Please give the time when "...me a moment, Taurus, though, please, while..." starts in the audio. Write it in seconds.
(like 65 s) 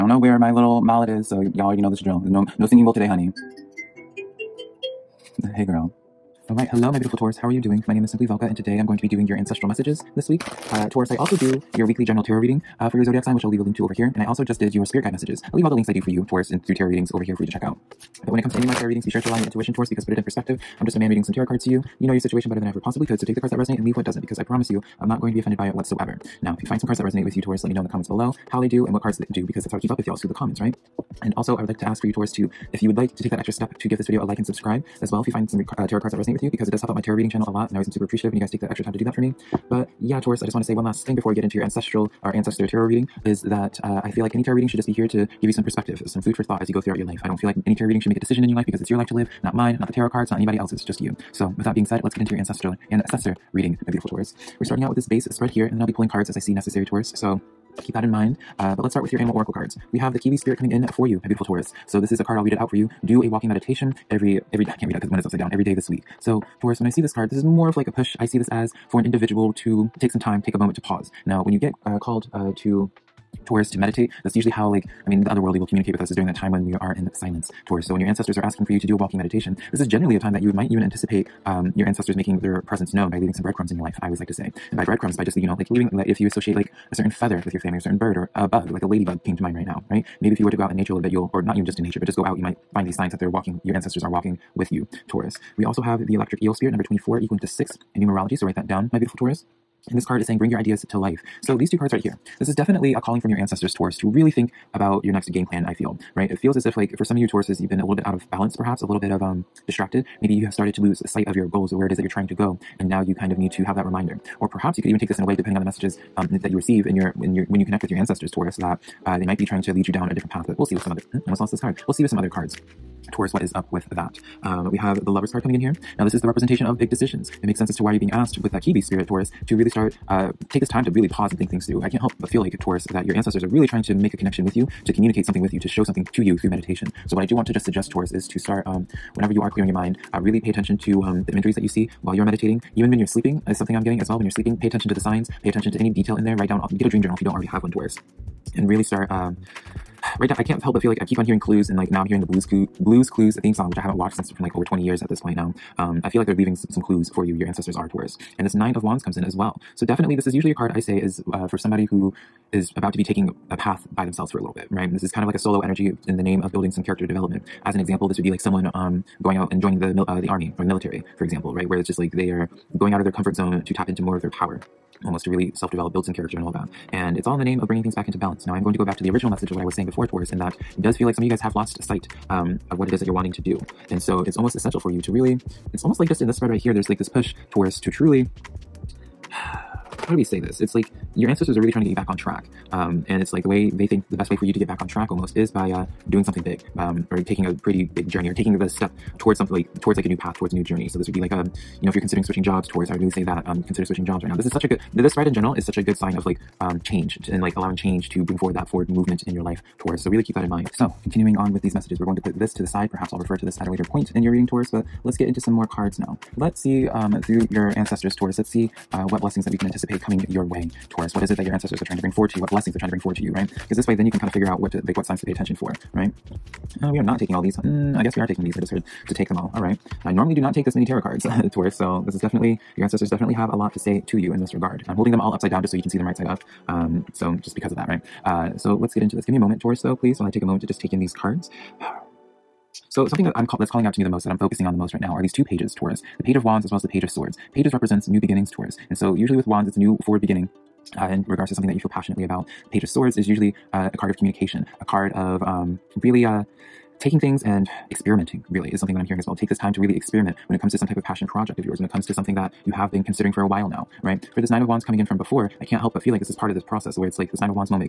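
239 s.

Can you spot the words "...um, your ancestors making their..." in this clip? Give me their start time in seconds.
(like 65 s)
81 s.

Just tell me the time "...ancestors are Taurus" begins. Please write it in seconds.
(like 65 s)
157 s.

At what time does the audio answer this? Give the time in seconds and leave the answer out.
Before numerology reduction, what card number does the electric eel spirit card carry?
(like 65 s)
96 s.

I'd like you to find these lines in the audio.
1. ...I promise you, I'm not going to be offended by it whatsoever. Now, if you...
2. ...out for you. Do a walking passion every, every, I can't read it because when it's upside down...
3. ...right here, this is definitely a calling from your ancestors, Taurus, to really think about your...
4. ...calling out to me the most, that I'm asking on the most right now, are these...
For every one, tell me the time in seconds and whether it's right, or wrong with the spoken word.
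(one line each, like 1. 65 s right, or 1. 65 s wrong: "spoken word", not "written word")
1. 24 s right
2. 62 s wrong: "meditation", not "passion"
3. 101 s right
4. 243 s wrong: "focusing", not "asking".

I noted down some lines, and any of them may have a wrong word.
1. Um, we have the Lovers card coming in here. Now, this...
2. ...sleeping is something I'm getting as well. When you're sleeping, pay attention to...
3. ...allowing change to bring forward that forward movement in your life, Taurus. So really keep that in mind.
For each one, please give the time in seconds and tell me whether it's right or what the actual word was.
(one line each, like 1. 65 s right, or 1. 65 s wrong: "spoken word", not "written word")
1. 124 s right
2. 143 s right
3. 207 s right.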